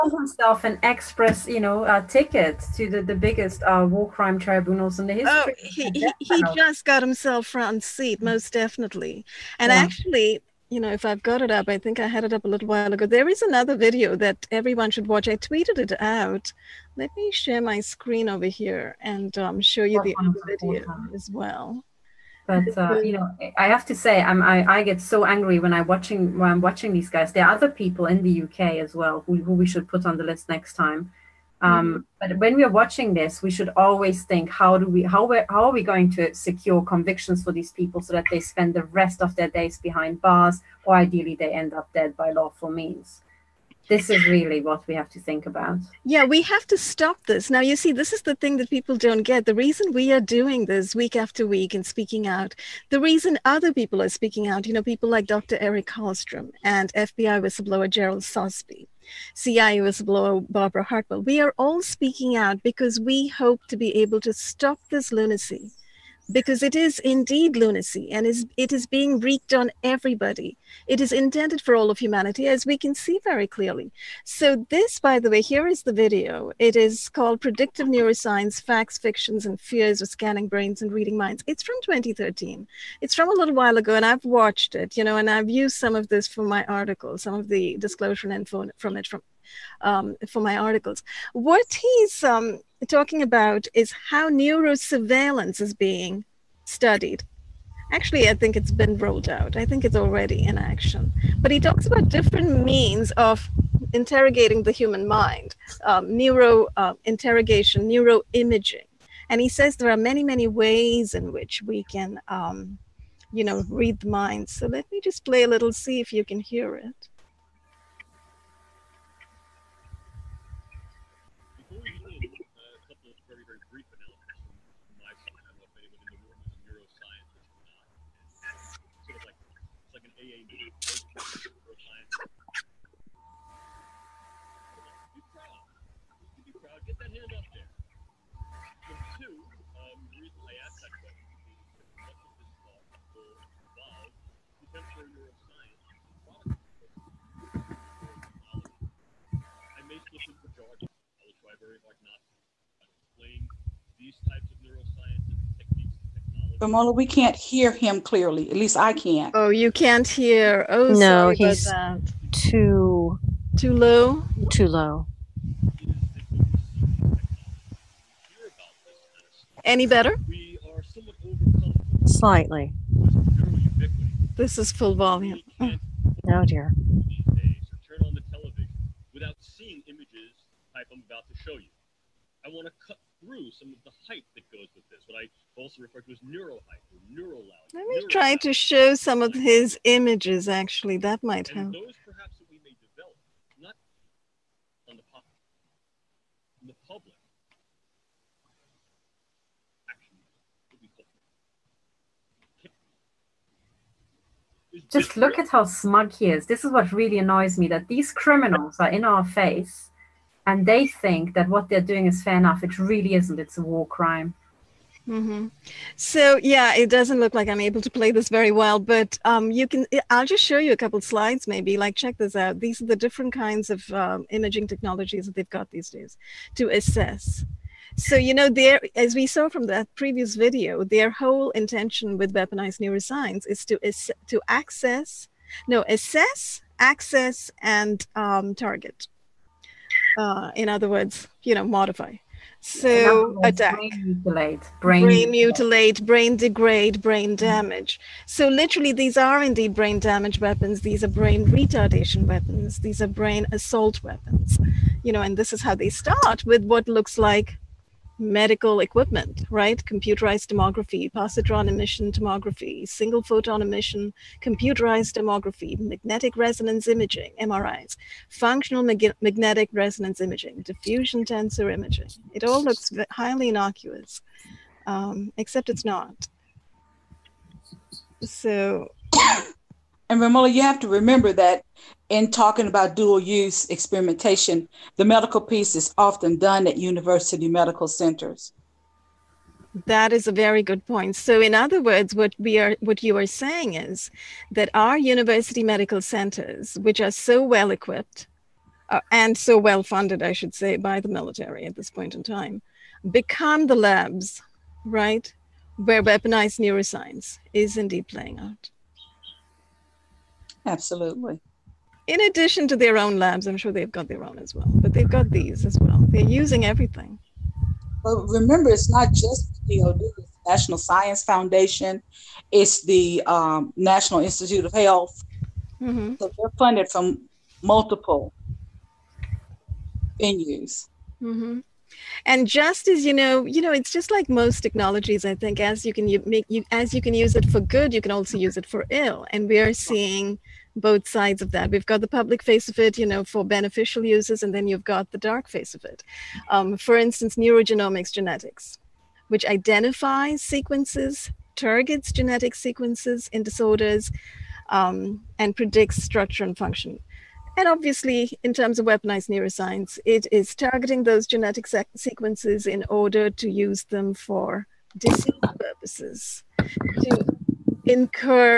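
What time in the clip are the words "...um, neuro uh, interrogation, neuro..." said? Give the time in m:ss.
1:45.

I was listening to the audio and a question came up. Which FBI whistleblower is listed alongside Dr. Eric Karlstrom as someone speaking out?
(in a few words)
Gerald Sosbee.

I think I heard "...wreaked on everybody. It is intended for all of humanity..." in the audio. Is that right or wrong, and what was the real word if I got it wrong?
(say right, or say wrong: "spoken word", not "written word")
right.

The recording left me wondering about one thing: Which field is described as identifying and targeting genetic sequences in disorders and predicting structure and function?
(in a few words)
neurogenomics.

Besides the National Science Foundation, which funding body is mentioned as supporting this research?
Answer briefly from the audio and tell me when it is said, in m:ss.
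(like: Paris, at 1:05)
National Institute of Health, at 5:23.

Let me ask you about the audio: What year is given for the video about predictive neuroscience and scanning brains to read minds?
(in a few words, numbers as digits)
2013.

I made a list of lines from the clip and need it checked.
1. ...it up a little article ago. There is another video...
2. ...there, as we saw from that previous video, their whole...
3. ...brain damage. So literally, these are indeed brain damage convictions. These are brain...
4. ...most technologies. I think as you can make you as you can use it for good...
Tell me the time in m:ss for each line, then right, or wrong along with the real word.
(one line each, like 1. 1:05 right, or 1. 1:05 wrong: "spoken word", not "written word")
1. 0:12 wrong: "while", not "article"
2. 3:48 right
3. 4:07 wrong: "weapons", not "convictions"
4. 5:34 right.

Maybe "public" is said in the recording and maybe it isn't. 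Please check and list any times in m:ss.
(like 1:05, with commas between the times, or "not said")
3:16, 5:42.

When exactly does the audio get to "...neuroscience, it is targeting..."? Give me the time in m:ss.
5:59.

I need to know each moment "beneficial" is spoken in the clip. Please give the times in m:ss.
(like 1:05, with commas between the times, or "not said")
5:43.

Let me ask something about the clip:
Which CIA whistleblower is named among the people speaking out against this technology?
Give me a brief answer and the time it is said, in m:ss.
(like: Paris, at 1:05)
Barbara Hartwell, at 1:00.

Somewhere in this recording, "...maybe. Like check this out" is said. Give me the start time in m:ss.
3:41.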